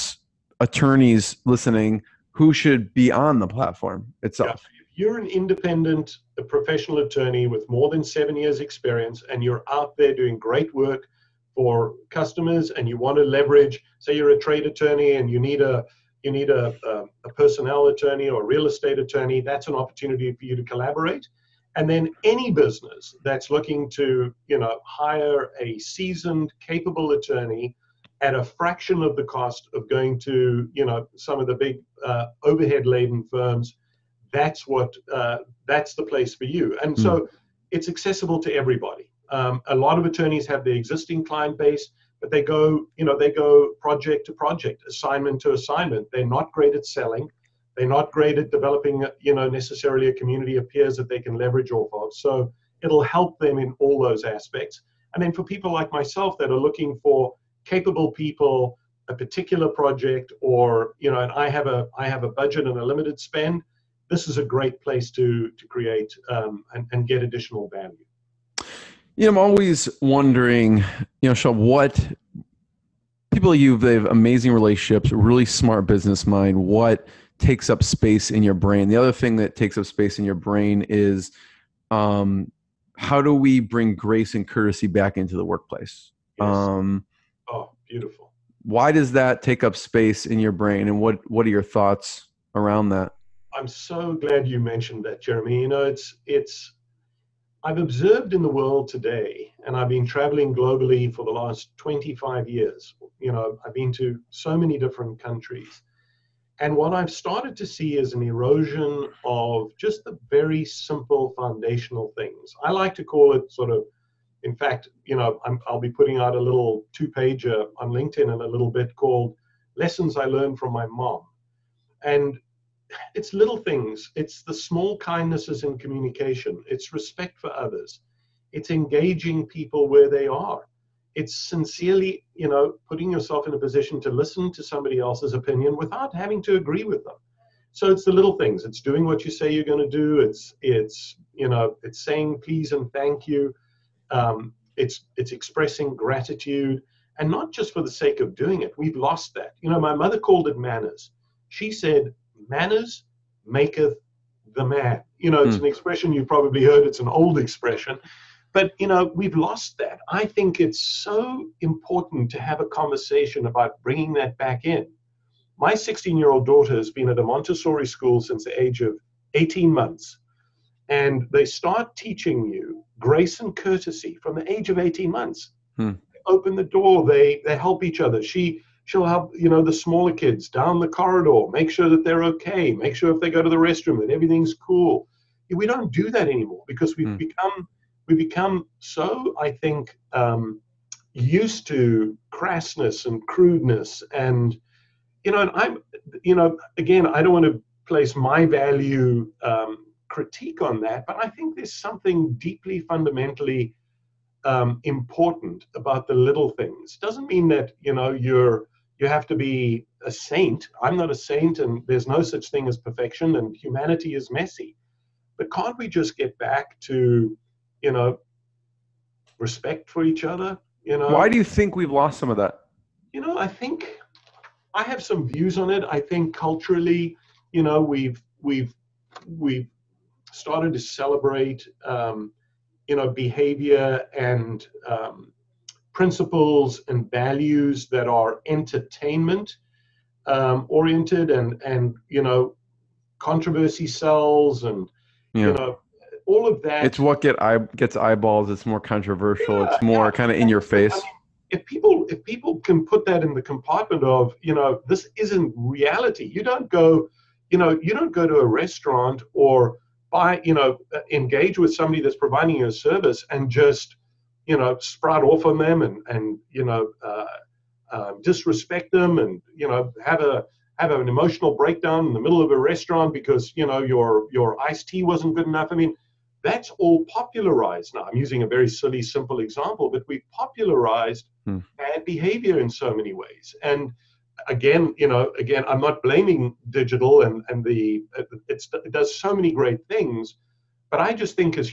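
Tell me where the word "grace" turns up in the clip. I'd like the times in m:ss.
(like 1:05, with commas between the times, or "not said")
1:23, 2:52.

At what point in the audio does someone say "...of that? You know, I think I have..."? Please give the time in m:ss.
3:42.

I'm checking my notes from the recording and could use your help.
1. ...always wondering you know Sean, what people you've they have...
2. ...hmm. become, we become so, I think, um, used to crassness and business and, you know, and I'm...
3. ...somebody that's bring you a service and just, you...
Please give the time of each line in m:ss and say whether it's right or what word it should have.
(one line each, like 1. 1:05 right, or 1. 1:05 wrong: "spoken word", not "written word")
1. 1:09 right
2. 3:07 wrong: "crudeness", not "business"
3. 4:21 wrong: "providing", not "bring".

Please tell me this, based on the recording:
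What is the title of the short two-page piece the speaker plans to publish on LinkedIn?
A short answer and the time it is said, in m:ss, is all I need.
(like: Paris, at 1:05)
Lessons I Learned from My Mom, at 1:59.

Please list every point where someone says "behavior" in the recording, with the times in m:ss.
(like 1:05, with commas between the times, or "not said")
3:53, 4:42.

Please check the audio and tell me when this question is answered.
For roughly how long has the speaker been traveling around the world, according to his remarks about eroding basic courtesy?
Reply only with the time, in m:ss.
1:41.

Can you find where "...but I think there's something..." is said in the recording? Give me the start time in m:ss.
3:21.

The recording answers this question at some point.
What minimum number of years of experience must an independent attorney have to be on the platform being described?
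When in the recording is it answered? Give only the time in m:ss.
0:08.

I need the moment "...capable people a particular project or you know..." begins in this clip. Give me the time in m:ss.
0:57.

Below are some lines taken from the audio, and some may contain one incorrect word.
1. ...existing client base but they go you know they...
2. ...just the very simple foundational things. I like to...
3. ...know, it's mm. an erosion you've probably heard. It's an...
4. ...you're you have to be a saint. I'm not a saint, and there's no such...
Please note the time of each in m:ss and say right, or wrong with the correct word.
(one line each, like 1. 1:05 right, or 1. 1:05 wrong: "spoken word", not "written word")
1. 0:40 right
2. 1:49 right
3. 2:35 wrong: "expression", not "erosion"
4. 3:28 right.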